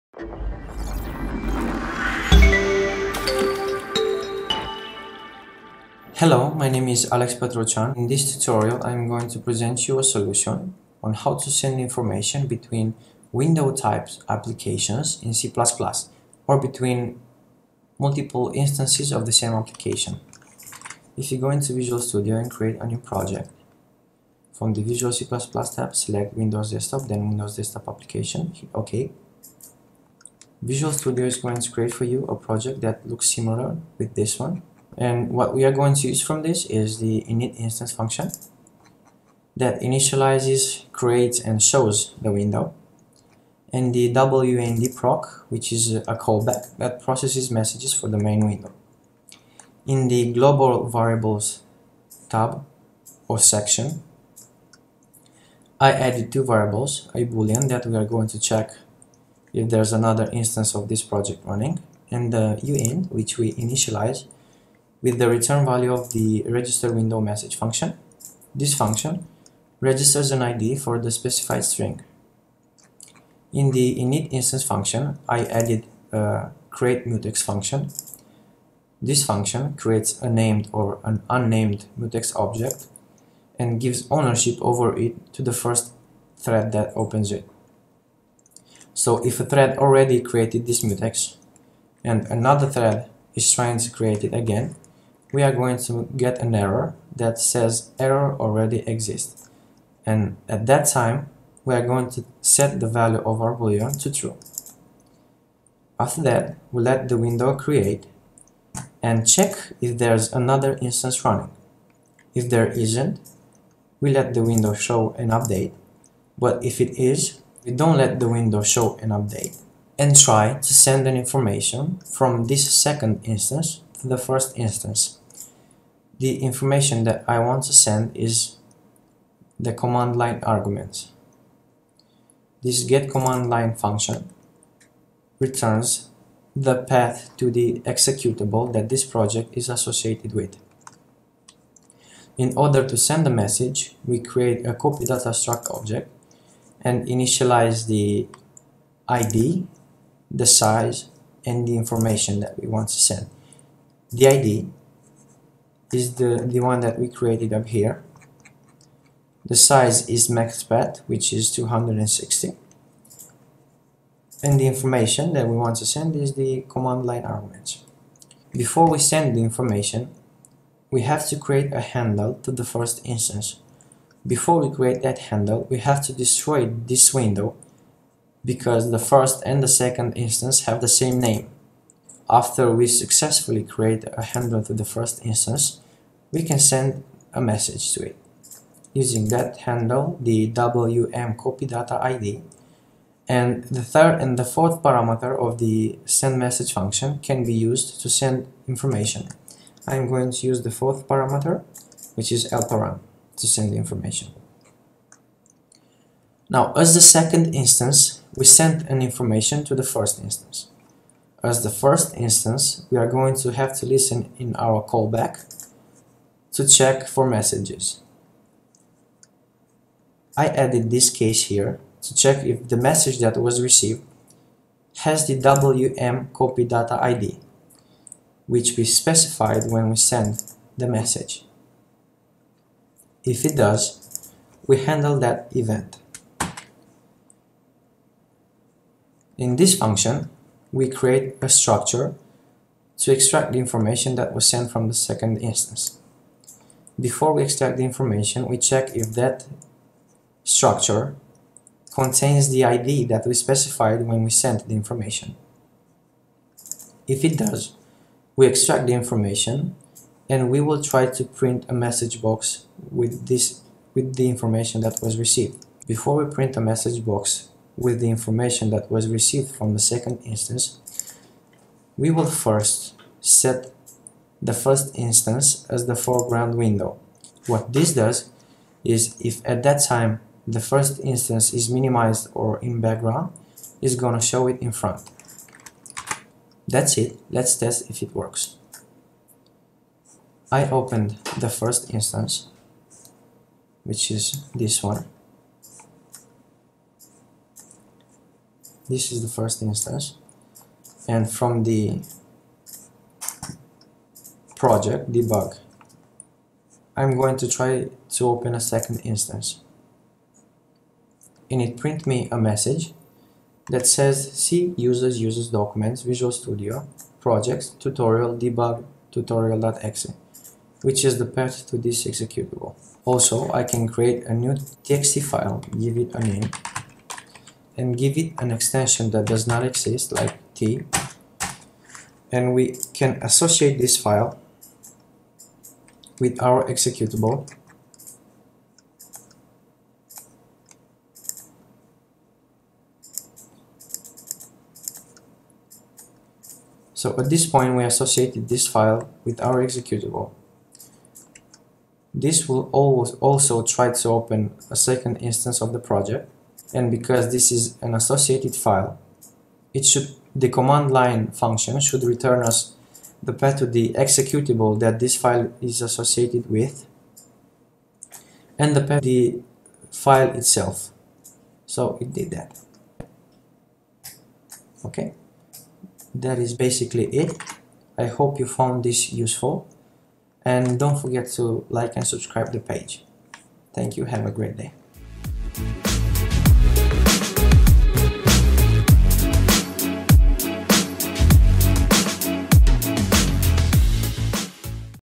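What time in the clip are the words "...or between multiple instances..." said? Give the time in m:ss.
0:16.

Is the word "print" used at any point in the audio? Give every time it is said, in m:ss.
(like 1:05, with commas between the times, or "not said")
4:21, 4:26, 5:11.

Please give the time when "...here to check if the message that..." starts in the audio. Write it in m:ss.
3:41.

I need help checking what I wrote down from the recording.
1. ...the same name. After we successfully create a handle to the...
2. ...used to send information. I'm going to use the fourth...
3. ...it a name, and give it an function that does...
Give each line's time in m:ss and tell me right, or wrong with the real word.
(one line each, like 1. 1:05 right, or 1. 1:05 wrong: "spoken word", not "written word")
1. 3:00 right
2. 3:17 right
3. 5:25 wrong: "extension", not "function".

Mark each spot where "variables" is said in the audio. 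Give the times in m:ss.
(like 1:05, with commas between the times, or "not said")
0:50, 0:56.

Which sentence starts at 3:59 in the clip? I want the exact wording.
In this function, we create a structure to extract the information that was sent from the second instance.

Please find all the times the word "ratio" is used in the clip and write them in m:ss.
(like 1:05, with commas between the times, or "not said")
not said.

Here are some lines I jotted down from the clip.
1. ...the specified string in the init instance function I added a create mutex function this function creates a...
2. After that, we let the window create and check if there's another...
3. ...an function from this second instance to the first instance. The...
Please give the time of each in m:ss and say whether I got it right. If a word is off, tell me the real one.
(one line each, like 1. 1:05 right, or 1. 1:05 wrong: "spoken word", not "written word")
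1. 1:10 right
2. 1:45 right
3. 2:01 wrong: "information", not "function".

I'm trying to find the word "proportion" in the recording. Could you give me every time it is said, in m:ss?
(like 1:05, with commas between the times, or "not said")
not said.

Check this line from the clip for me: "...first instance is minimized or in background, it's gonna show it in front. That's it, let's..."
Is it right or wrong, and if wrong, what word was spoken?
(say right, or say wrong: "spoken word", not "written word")
right.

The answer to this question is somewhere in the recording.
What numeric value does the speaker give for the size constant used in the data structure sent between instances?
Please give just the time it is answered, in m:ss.
2:41.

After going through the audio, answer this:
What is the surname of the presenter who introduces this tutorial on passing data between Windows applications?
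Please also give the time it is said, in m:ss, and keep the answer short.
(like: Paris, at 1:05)
Patraucean, at 0:07.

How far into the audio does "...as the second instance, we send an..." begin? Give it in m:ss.
3:26.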